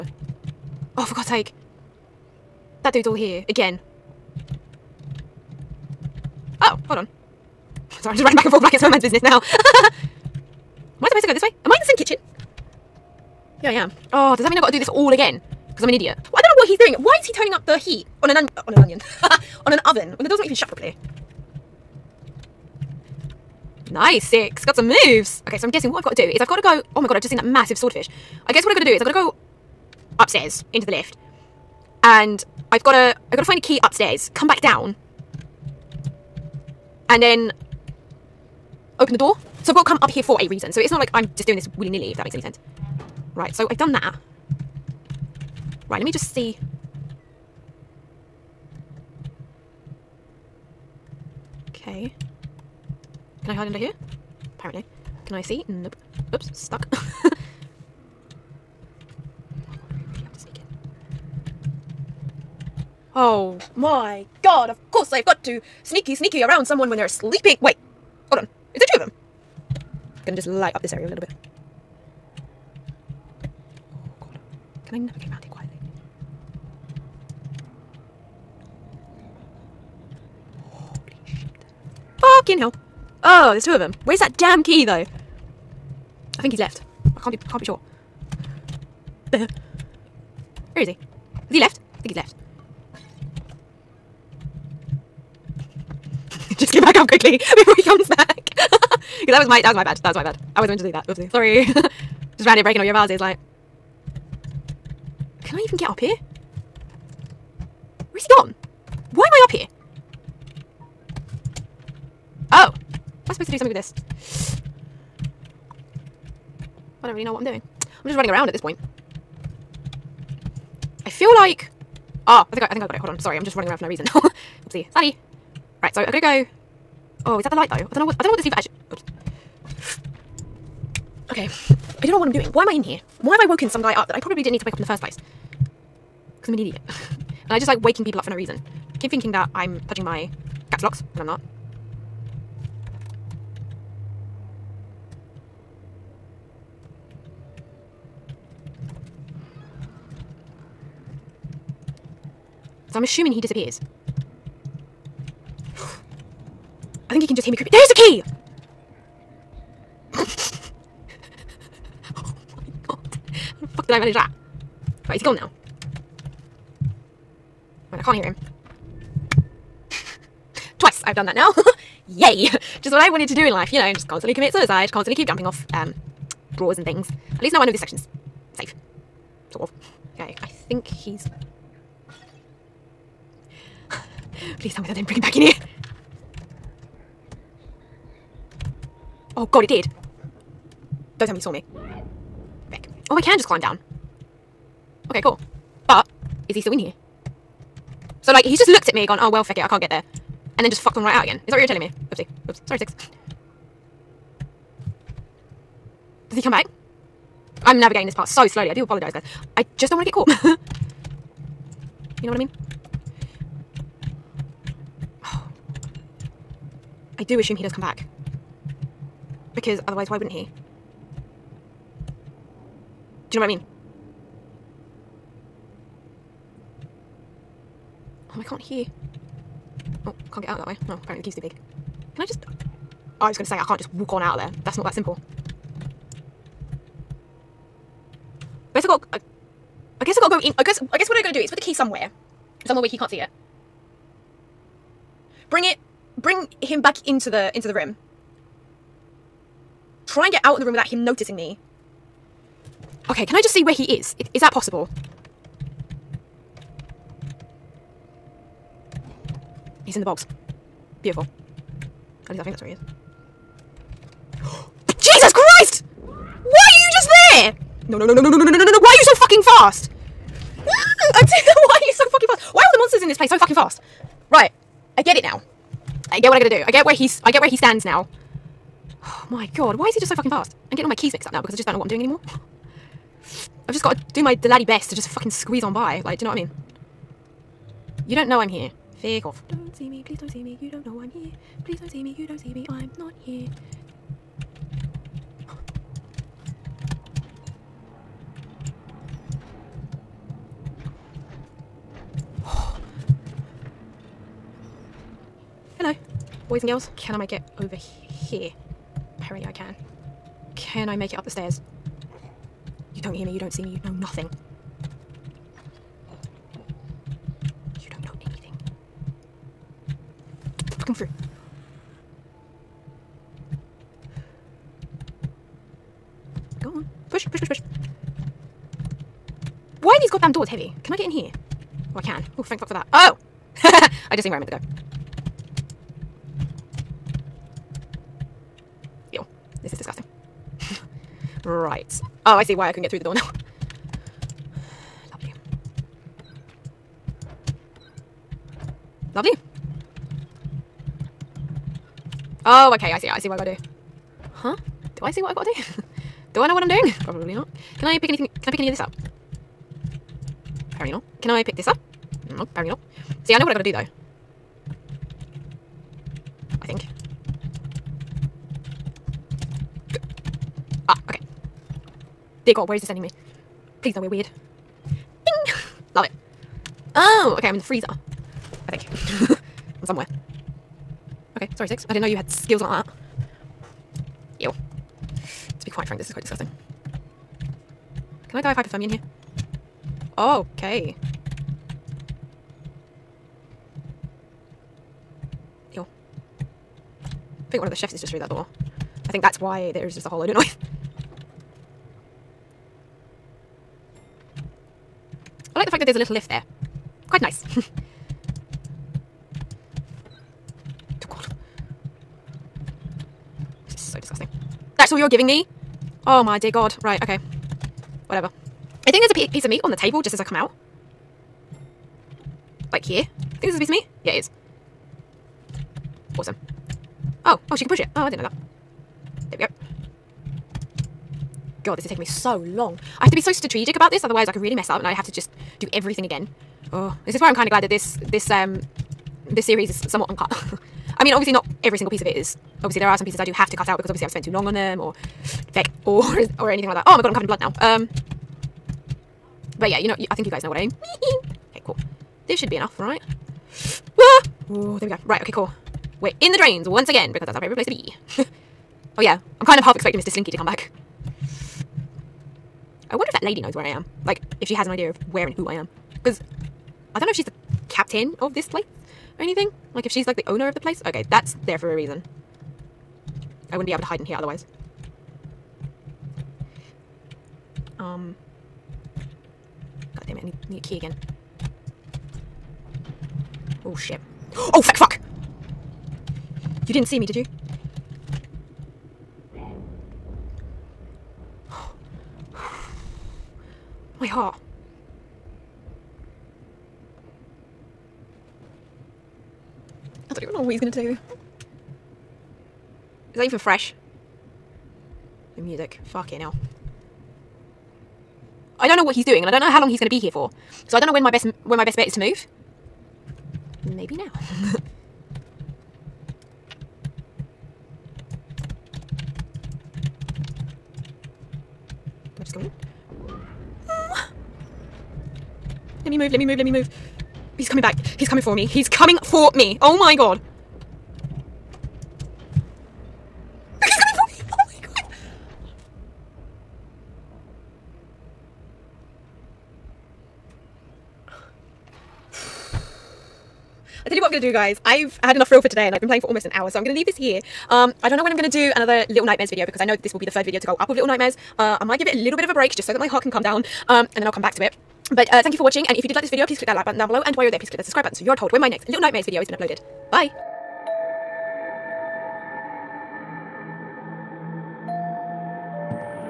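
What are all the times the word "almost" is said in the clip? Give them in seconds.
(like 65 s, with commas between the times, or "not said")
546 s.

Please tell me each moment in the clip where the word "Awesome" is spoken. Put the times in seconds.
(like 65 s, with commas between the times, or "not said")
426 s.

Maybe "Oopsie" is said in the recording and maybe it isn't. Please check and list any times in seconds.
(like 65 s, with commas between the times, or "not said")
101 s, 124 s, 202 s.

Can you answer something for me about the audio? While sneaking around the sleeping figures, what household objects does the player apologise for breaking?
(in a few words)
vases.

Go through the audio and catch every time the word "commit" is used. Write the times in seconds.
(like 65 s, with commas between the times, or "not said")
174 s.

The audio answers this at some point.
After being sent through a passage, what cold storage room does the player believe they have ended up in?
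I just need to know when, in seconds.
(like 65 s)
377 s.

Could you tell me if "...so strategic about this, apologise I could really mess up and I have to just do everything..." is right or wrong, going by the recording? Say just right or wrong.
wrong.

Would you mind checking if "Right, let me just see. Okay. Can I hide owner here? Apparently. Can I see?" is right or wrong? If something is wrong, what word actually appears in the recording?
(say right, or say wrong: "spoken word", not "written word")
wrong: "under", not "owner".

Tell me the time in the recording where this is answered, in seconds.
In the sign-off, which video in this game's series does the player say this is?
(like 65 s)
550 s.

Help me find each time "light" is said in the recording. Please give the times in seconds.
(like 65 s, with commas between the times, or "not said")
70 s, 127 s.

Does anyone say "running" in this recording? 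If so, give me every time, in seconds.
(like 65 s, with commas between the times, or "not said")
8 s, 118 s, 123 s.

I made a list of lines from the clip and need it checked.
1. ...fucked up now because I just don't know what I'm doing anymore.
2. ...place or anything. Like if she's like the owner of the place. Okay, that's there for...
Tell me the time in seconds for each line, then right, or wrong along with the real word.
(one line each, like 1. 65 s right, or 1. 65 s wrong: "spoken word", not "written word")
1. 281 s wrong: "mixed", not "fucked"
2. 468 s right.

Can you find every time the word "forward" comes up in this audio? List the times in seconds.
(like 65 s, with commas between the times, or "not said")
not said.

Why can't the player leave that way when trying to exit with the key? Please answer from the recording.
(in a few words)
the key's too big.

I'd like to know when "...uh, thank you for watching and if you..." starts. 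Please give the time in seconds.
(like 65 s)
555 s.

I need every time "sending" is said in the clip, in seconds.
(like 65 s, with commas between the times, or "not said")
372 s.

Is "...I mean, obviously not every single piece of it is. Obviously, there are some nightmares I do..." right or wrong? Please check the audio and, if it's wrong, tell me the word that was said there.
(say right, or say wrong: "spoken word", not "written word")
wrong: "pieces", not "nightmares".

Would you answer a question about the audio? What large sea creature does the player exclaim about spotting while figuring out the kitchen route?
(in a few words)
swordfish.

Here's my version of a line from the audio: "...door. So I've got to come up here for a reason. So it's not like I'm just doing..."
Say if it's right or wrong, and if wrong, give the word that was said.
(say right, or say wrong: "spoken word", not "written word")
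right.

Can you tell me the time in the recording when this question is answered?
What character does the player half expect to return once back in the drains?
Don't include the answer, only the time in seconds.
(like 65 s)
459 s.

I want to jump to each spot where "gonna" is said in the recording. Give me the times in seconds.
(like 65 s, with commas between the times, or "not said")
70 s, 126 s, 500 s.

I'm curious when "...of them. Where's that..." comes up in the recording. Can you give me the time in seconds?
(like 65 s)
83 s.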